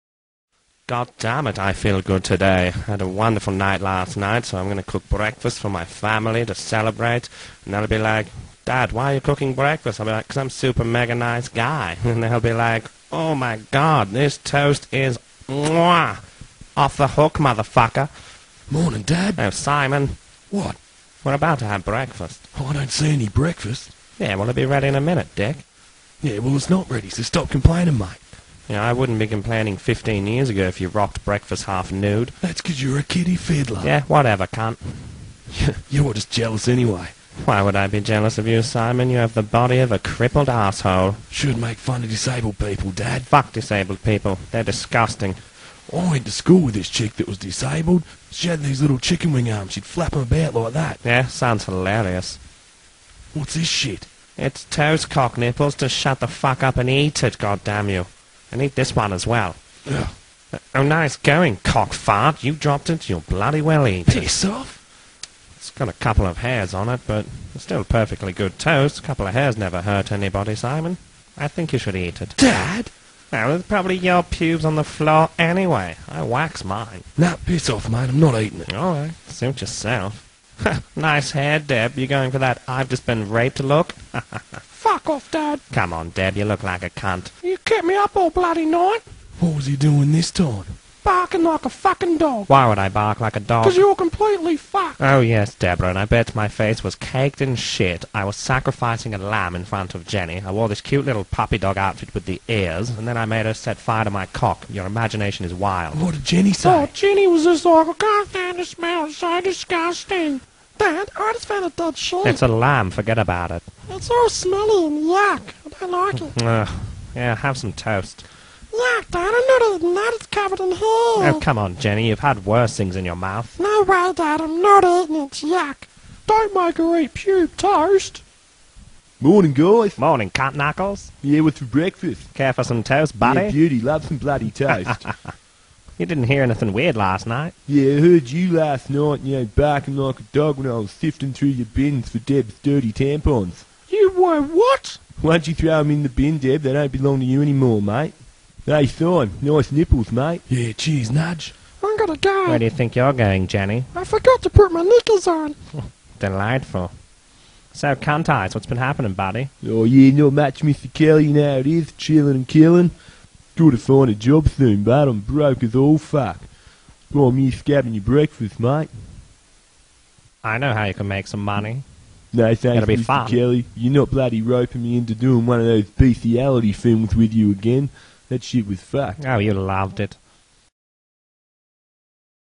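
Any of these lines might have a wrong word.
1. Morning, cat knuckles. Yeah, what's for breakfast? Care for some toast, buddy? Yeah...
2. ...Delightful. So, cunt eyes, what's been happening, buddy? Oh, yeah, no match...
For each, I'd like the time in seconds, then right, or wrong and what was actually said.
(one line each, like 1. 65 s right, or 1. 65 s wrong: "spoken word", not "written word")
1. 129 s right
2. 156 s right.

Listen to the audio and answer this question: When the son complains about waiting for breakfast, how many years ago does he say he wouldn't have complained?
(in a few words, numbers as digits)
15.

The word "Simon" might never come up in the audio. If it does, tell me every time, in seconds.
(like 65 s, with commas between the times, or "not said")
19 s, 38 s, 70 s.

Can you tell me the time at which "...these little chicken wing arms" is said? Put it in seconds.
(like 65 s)
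48 s.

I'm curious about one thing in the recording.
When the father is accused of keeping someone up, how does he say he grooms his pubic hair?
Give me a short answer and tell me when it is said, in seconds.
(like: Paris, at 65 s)
Wax, at 76 s.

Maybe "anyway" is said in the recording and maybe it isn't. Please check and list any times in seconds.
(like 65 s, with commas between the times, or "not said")
36 s, 75 s.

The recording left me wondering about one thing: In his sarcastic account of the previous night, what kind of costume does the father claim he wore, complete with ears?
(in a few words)
Puppy dog outfit.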